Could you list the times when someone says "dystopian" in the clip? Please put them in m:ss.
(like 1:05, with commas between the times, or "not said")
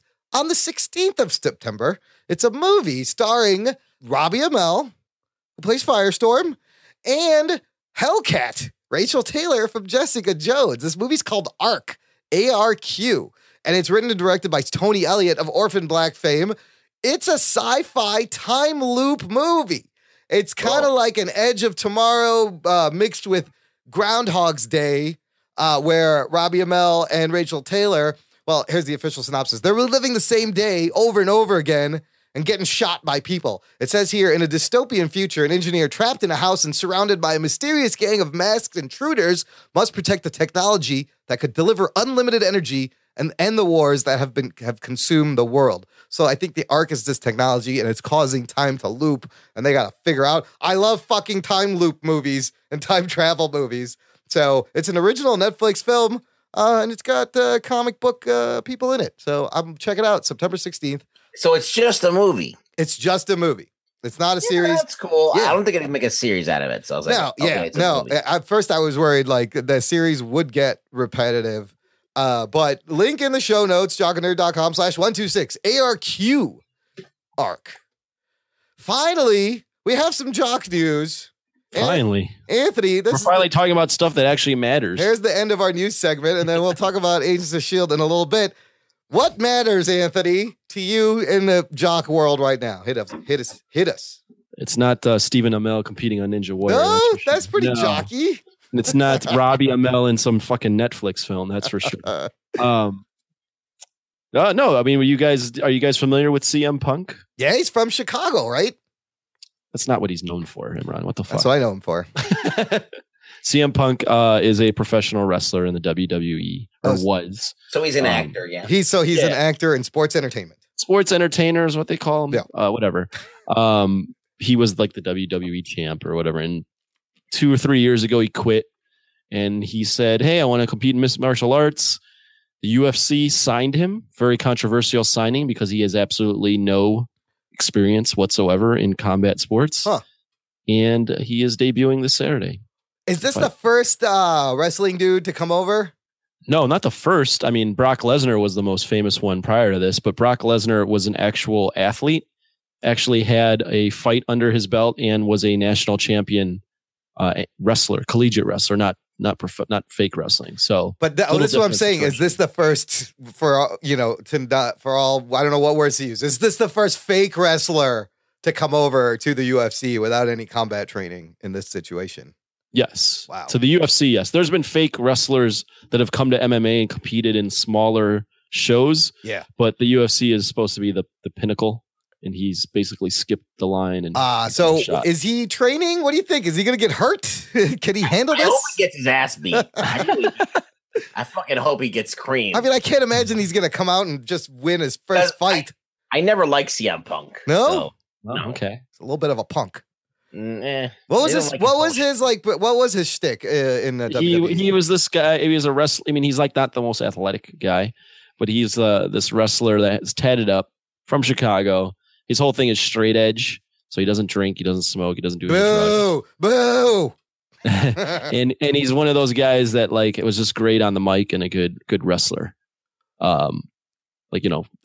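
0:34.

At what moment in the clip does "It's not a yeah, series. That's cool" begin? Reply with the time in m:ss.
1:04.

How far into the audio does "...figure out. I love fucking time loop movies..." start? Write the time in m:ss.
0:50.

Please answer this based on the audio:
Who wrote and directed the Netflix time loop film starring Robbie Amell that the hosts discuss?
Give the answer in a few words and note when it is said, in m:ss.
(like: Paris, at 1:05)
Tony Elliott, at 0:14.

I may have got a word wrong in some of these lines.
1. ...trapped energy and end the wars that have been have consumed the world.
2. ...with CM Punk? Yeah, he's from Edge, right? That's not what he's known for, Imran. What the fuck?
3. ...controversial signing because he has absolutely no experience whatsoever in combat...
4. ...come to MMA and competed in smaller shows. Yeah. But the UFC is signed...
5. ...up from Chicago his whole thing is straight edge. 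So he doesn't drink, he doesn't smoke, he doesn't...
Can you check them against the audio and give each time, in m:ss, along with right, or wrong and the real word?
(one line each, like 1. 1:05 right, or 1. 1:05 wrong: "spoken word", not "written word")
1. 0:41 wrong: "unlimited", not "trapped"
2. 1:46 wrong: "Chicago", not "Edge"
3. 2:14 right
4. 2:56 wrong: "supposed", not "signed"
5. 3:30 right.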